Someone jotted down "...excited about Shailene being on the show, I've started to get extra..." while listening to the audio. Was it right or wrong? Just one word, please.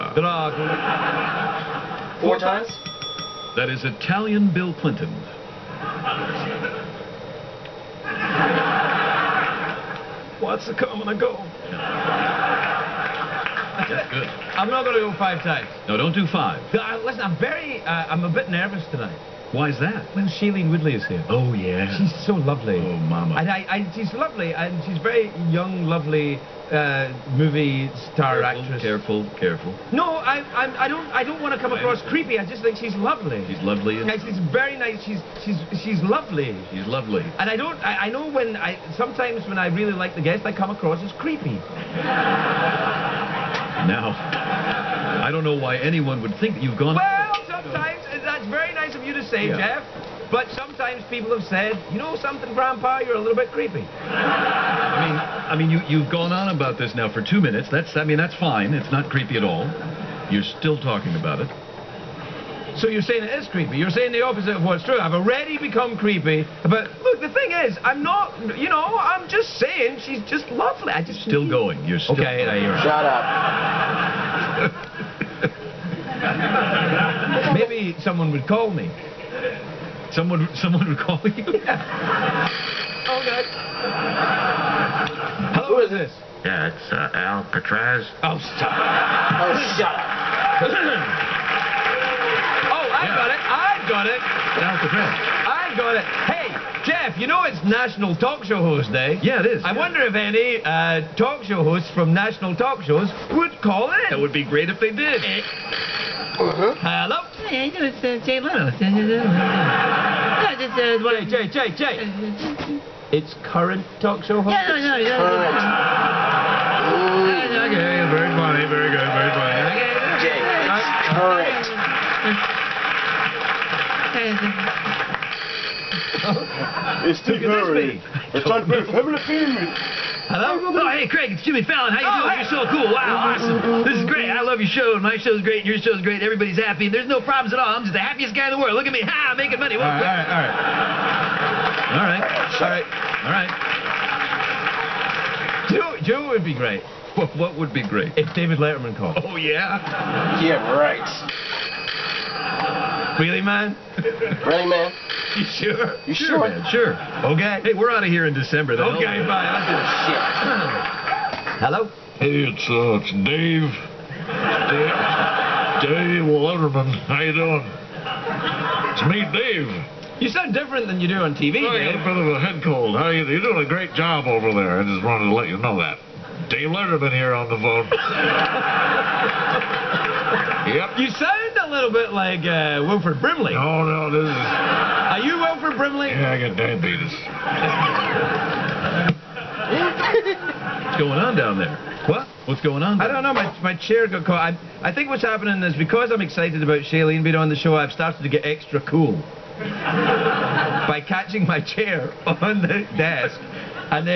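right.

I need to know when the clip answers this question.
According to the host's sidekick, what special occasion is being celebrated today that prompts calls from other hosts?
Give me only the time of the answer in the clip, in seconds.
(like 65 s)
97 s.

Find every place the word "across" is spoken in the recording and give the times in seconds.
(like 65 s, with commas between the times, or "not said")
31 s, 40 s.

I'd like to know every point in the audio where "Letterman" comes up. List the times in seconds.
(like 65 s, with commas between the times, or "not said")
148 s, 166 s, 176 s.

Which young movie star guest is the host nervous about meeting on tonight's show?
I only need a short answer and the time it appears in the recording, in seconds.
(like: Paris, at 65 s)
Shailene Woodley, at 20 s.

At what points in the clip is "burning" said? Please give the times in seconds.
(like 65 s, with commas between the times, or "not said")
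not said.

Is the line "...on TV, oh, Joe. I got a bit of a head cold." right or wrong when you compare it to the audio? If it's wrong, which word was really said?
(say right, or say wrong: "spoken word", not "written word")
wrong: "Dave", not "Joe".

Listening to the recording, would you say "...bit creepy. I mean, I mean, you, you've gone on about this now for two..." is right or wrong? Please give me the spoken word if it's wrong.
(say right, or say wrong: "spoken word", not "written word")
right.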